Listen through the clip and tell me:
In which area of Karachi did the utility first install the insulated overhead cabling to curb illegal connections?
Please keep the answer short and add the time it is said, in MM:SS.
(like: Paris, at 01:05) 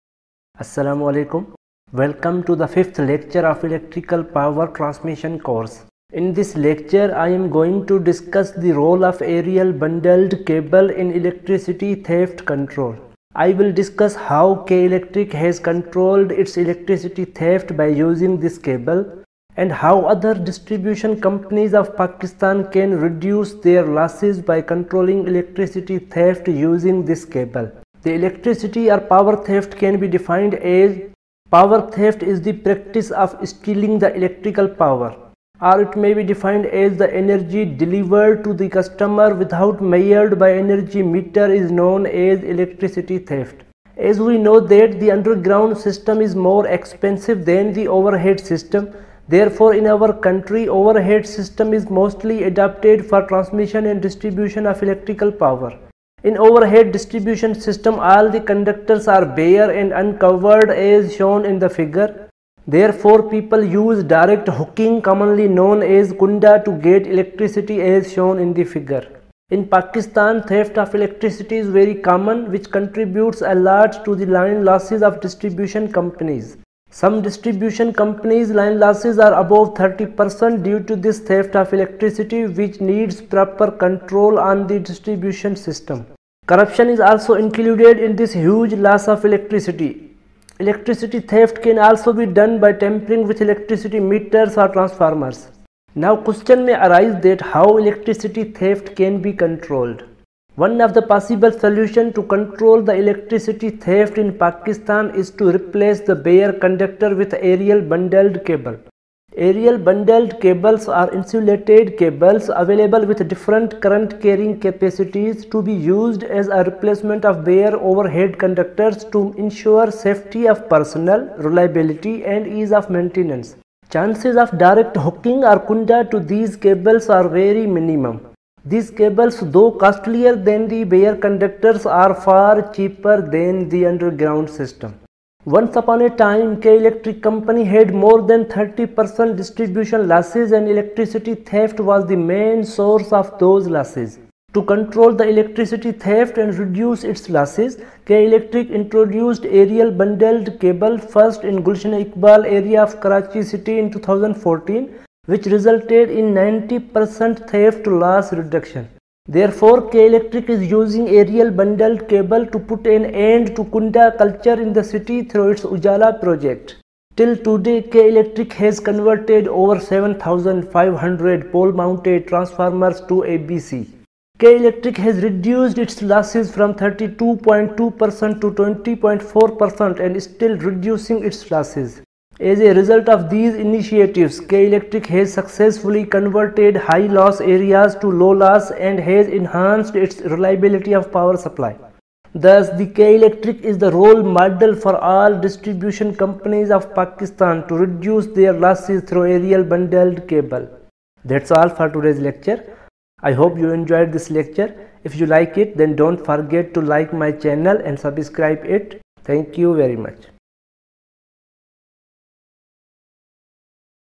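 Gulshan Iqbal, at 02:31.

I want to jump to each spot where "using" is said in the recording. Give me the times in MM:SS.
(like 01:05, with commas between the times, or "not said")
00:17, 00:26, 02:40.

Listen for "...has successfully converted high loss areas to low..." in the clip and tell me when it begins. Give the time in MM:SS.
03:05.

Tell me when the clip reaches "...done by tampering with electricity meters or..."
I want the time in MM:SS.
01:32.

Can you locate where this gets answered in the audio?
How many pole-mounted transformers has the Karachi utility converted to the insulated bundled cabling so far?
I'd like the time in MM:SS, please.
02:49.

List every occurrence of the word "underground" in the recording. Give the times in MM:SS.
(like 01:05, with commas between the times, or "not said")
00:45, 02:13.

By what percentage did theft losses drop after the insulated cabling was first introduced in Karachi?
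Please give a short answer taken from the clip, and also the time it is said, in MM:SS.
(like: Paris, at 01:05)
90%, at 02:36.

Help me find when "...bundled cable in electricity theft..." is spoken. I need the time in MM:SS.
00:09.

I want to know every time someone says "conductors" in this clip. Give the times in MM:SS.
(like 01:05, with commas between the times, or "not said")
00:58, 01:46, 01:58, 02:11.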